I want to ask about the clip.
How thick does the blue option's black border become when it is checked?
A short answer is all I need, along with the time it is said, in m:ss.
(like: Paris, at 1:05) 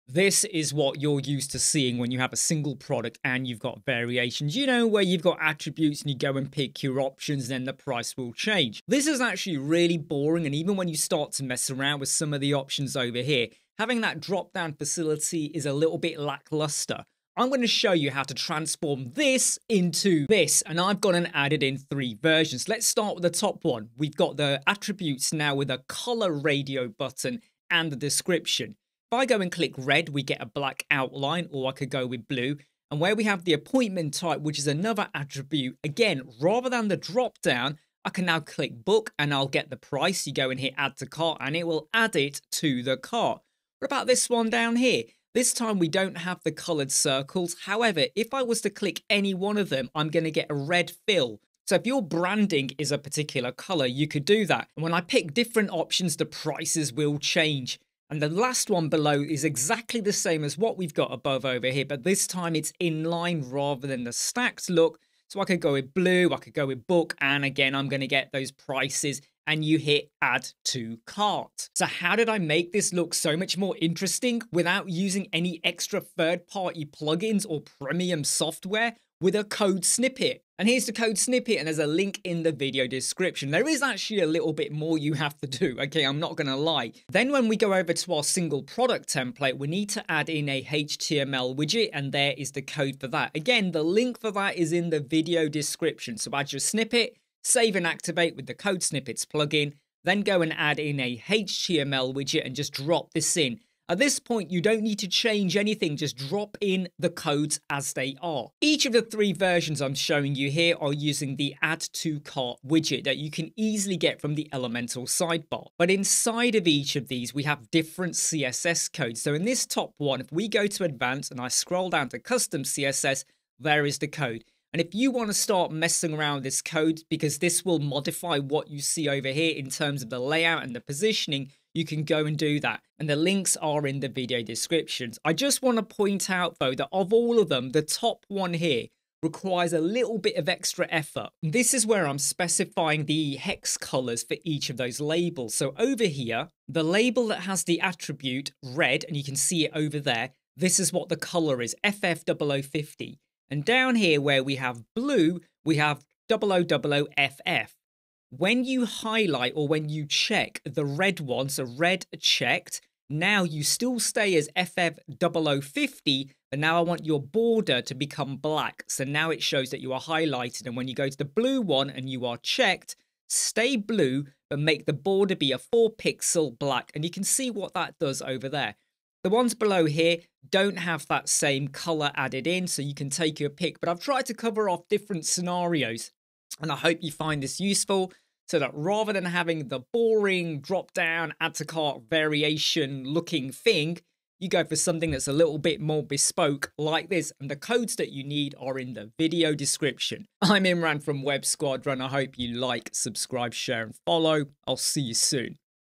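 4 pixels, at 2:55.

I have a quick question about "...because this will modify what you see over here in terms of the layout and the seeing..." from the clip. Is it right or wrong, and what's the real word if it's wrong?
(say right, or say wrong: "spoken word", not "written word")
wrong: "positioning", not "seeing".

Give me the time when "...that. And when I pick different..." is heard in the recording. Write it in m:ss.
0:54.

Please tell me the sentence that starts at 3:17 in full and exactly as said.
And the codes that you need are in the video description.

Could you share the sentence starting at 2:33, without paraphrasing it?
And down here where we have blue, we have 0000FF.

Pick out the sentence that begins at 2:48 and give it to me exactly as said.
So now it shows that you are highlighted.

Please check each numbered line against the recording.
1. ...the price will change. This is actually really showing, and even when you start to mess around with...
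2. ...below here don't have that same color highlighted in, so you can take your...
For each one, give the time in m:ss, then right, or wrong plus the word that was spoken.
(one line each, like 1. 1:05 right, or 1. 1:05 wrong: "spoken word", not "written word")
1. 0:07 wrong: "boring", not "showing"
2. 2:59 wrong: "added", not "highlighted".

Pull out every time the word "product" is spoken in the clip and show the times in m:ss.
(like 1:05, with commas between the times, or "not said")
0:02, 1:28.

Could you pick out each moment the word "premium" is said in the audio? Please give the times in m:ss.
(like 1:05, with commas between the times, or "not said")
1:17.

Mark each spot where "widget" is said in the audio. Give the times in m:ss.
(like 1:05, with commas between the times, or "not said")
1:31, 1:42, 1:52.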